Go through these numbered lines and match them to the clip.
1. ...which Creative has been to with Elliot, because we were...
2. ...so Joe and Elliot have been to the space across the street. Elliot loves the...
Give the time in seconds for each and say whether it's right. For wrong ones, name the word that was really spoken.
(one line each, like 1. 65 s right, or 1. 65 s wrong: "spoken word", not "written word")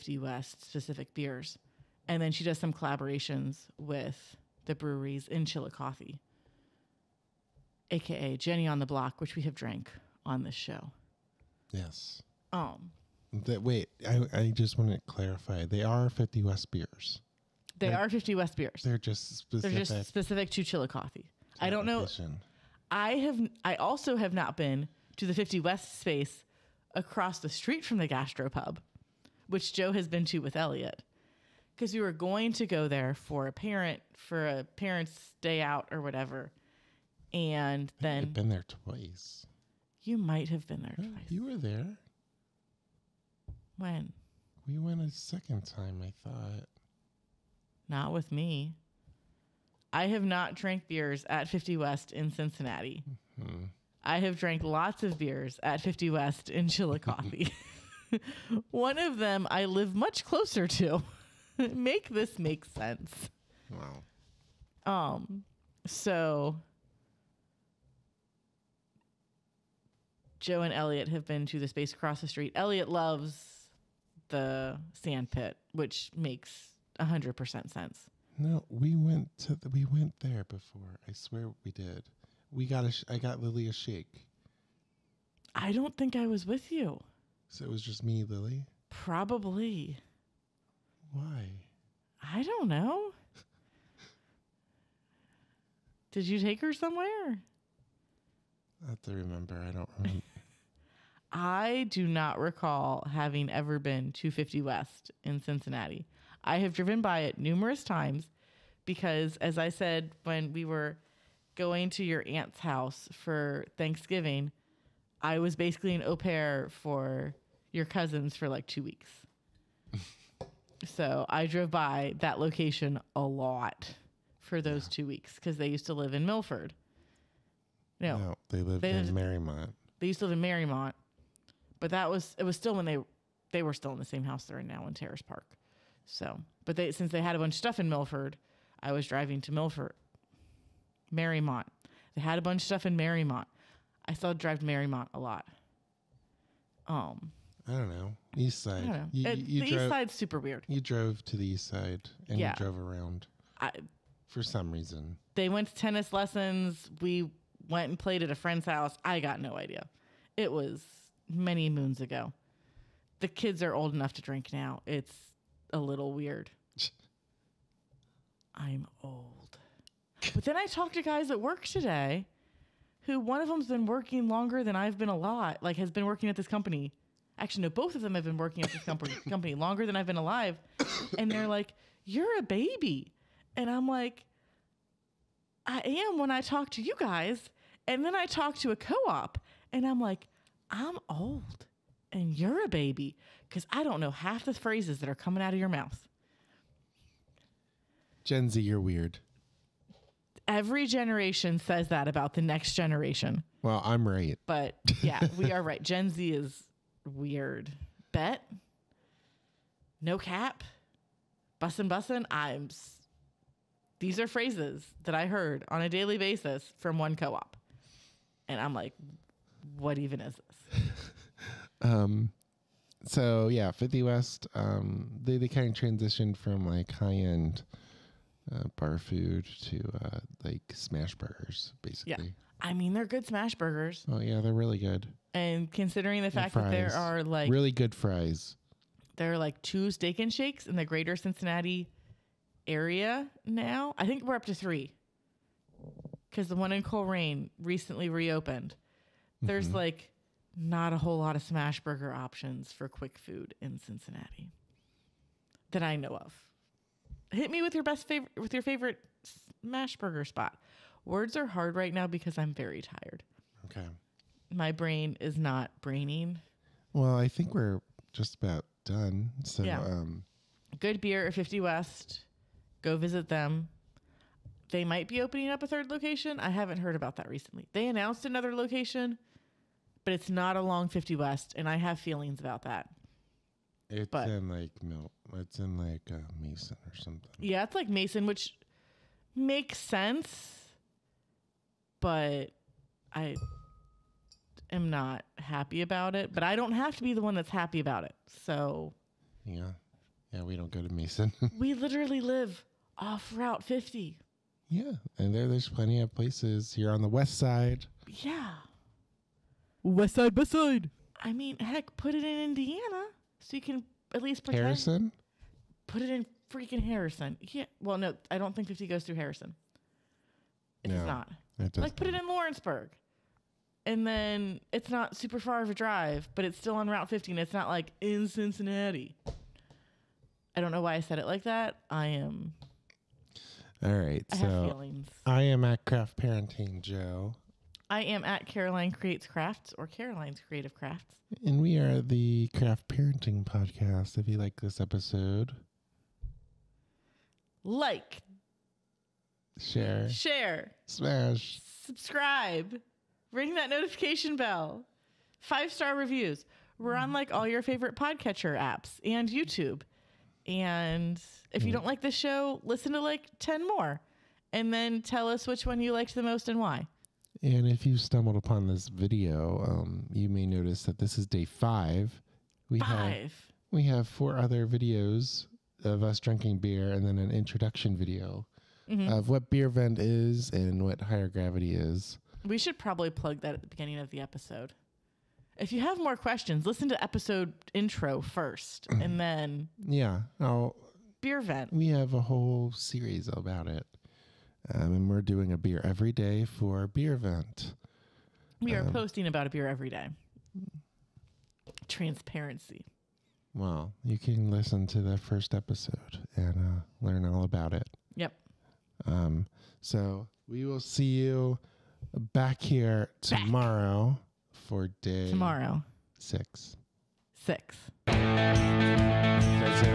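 1. 29 s wrong: "Joe", not "Creative"
2. 65 s right.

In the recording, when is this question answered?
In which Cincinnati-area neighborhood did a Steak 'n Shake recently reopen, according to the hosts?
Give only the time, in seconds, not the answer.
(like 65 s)
246 s.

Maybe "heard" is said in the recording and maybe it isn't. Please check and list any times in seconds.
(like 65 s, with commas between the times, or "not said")
215 s, 276 s.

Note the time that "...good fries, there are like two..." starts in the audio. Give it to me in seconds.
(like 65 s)
237 s.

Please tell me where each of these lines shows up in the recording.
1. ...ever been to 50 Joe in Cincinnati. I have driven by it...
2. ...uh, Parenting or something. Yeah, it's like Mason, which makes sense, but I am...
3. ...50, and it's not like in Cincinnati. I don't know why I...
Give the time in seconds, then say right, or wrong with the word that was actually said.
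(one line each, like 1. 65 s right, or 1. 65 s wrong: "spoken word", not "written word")
1. 103 s wrong: "West", not "Joe"
2. 286 s wrong: "Mason", not "Parenting"
3. 327 s right.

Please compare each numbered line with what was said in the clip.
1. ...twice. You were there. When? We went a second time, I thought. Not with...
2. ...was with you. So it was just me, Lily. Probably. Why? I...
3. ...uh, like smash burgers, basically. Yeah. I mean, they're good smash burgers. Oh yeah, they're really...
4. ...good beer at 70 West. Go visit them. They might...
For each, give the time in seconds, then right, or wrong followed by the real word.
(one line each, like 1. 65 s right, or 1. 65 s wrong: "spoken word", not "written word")
1. 40 s right
2. 86 s right
3. 230 s right
4. 270 s wrong: "50", not "70".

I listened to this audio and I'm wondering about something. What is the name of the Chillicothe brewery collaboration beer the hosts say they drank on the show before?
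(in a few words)
Jenny on the Block.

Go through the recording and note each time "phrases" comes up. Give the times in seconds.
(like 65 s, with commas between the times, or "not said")
194 s, 214 s.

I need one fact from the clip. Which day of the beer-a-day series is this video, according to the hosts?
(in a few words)
5.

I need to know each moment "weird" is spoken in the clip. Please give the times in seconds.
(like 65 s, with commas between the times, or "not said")
150 s, 166 s, 198 s, 207 s.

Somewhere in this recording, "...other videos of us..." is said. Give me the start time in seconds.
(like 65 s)
374 s.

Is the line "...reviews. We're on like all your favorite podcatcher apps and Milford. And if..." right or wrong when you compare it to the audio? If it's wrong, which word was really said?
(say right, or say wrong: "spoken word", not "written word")
wrong: "YouTube", not "Milford".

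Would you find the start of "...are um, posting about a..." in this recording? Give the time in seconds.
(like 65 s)
398 s.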